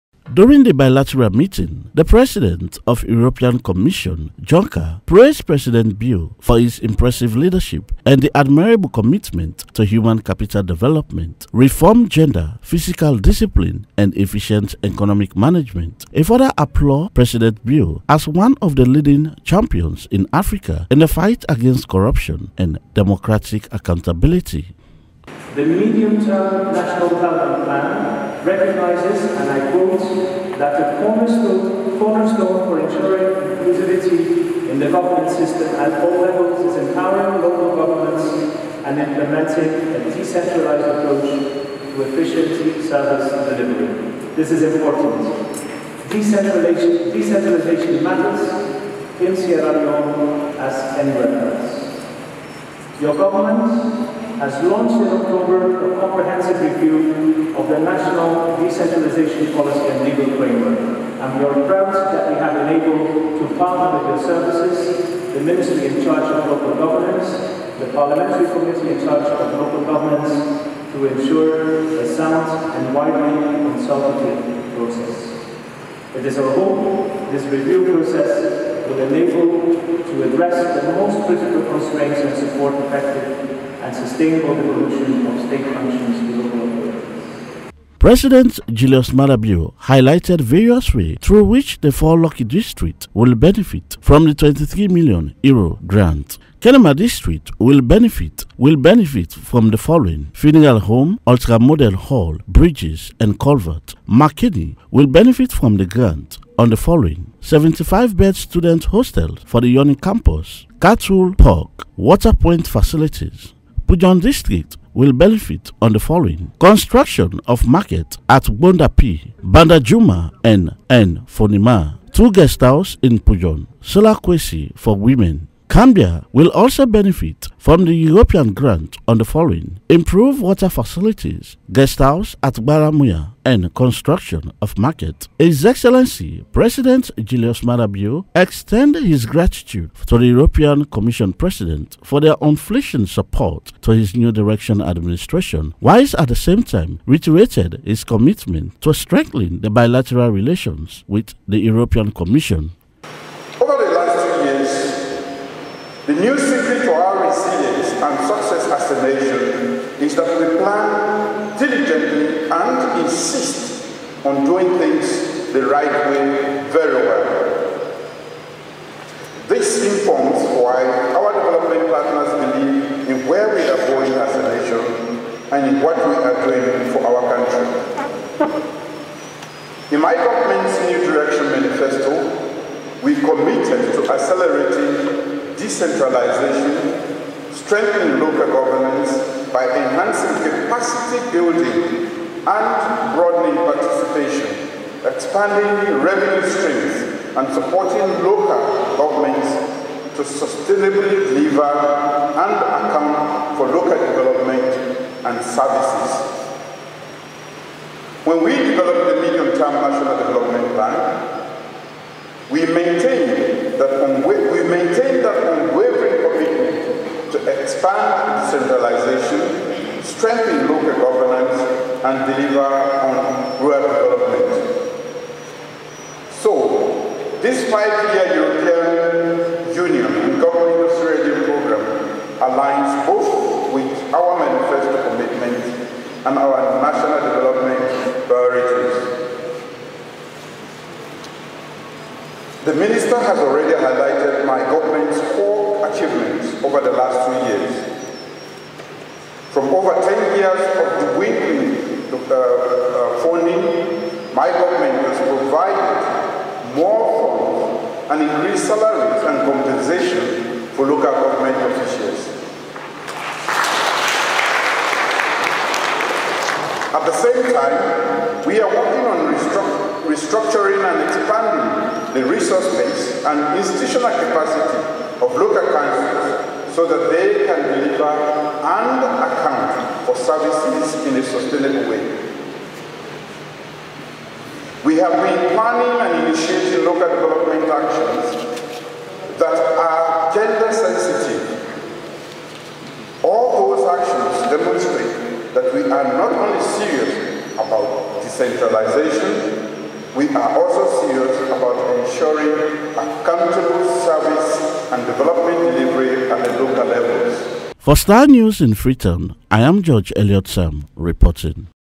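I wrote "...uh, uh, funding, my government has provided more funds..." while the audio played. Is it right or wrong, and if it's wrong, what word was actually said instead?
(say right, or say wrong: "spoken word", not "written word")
right.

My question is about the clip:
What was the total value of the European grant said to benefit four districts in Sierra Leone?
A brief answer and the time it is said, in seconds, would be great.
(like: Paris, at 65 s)
23 million euros, at 94 s.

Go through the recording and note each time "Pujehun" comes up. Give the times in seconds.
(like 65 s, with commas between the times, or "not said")
113 s, 123 s.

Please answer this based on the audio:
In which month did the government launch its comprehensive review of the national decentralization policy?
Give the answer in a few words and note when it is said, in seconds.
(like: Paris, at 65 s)
October, at 55 s.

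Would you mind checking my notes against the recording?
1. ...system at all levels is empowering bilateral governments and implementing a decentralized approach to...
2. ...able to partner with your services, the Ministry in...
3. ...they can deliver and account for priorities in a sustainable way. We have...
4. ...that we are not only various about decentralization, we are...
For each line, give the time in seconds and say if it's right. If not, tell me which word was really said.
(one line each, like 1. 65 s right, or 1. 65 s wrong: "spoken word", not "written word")
1. 35 s wrong: "local", not "bilateral"
2. 62 s right
3. 277 s wrong: "services", not "priorities"
4. 295 s wrong: "serious", not "various".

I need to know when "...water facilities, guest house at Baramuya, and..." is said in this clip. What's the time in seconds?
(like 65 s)
130 s.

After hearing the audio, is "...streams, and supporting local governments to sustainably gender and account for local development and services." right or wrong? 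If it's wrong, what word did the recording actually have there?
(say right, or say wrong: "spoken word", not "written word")
wrong: "deliver", not "gender".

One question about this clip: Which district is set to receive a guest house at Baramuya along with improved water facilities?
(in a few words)
Kambia.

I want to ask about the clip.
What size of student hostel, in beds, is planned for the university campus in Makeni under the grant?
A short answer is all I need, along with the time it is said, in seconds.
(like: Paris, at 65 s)
75, at 107 s.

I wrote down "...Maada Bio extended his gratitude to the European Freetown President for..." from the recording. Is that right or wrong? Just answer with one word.
wrong.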